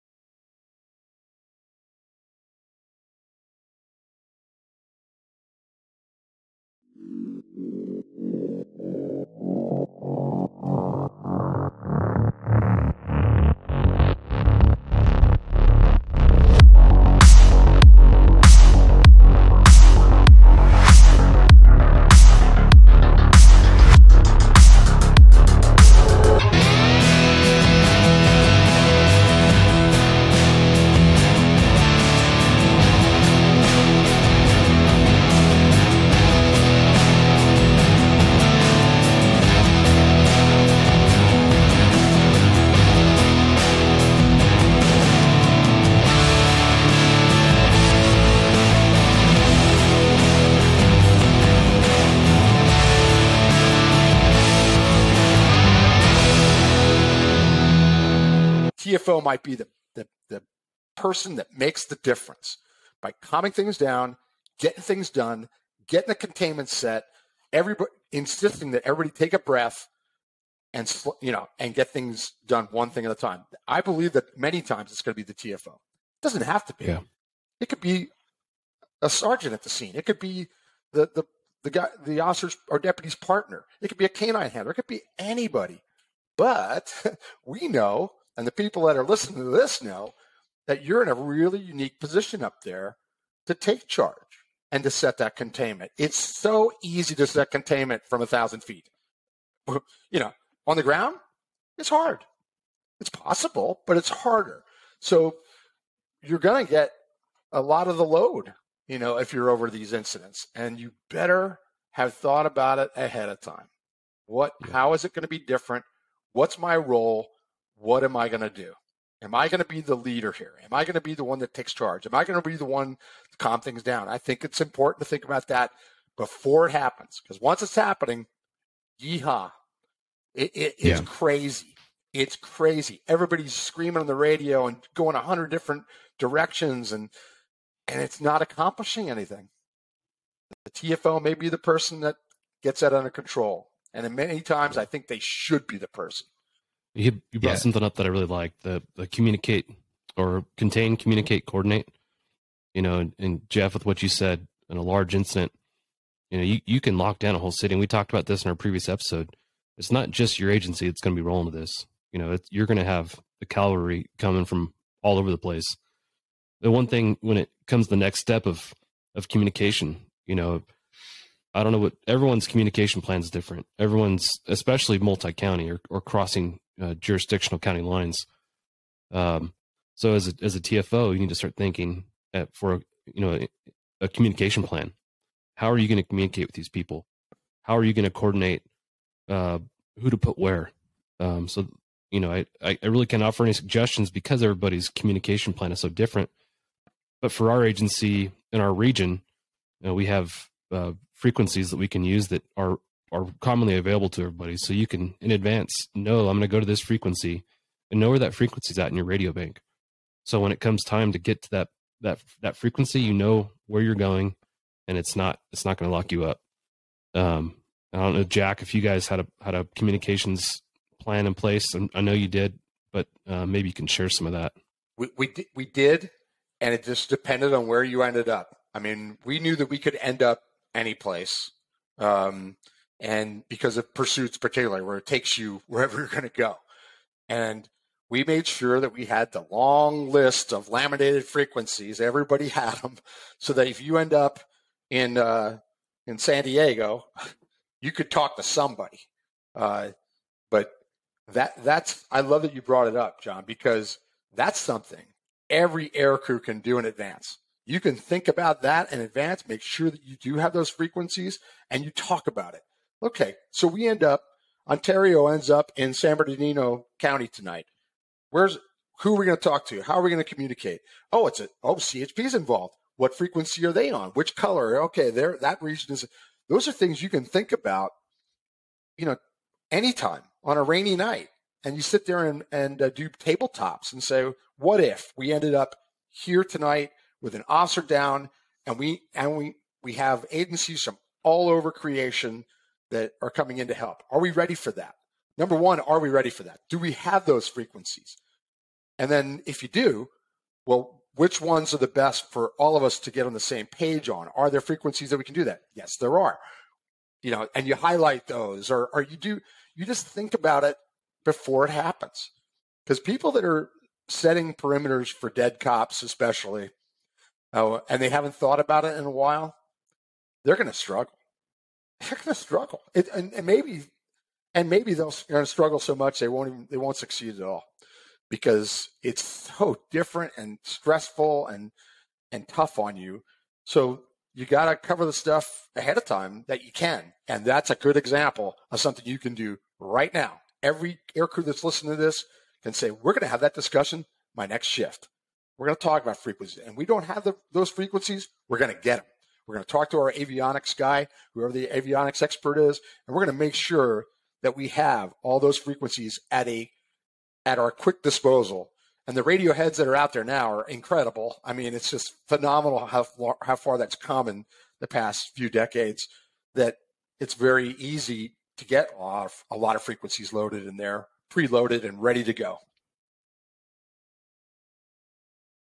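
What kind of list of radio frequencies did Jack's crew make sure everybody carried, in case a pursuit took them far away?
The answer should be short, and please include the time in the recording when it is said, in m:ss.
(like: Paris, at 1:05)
laminated, at 4:00.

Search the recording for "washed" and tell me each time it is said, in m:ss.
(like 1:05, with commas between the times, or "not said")
not said.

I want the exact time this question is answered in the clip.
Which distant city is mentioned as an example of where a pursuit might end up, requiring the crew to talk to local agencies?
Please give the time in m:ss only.
4:06.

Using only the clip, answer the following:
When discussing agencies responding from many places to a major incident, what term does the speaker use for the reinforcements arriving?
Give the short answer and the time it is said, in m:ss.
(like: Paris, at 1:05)
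the cavalry, at 2:43.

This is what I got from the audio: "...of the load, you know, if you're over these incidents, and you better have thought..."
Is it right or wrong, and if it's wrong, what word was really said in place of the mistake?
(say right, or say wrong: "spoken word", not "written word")
right.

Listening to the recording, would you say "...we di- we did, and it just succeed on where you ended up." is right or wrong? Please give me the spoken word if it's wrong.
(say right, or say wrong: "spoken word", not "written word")
wrong: "depended", not "succeed".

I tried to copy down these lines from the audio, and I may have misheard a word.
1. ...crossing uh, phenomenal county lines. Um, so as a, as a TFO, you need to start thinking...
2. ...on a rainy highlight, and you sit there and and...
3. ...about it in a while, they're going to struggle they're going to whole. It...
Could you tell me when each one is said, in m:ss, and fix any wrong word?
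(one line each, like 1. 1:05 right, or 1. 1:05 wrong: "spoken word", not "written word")
1. 2:55 wrong: "jurisdictional", not "phenomenal"
2. 4:40 wrong: "night", not "highlight"
3. 5:18 wrong: "struggle", not "whole".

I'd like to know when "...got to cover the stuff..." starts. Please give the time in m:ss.
5:34.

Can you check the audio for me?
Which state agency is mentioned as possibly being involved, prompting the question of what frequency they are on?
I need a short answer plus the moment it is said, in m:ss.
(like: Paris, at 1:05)
CHP, at 4:31.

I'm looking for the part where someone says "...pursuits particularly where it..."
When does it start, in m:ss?
3:53.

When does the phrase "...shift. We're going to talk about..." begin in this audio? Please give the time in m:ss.
5:44.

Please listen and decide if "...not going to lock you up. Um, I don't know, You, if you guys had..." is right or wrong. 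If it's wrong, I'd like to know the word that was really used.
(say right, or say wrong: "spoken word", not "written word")
wrong: "Jack", not "You".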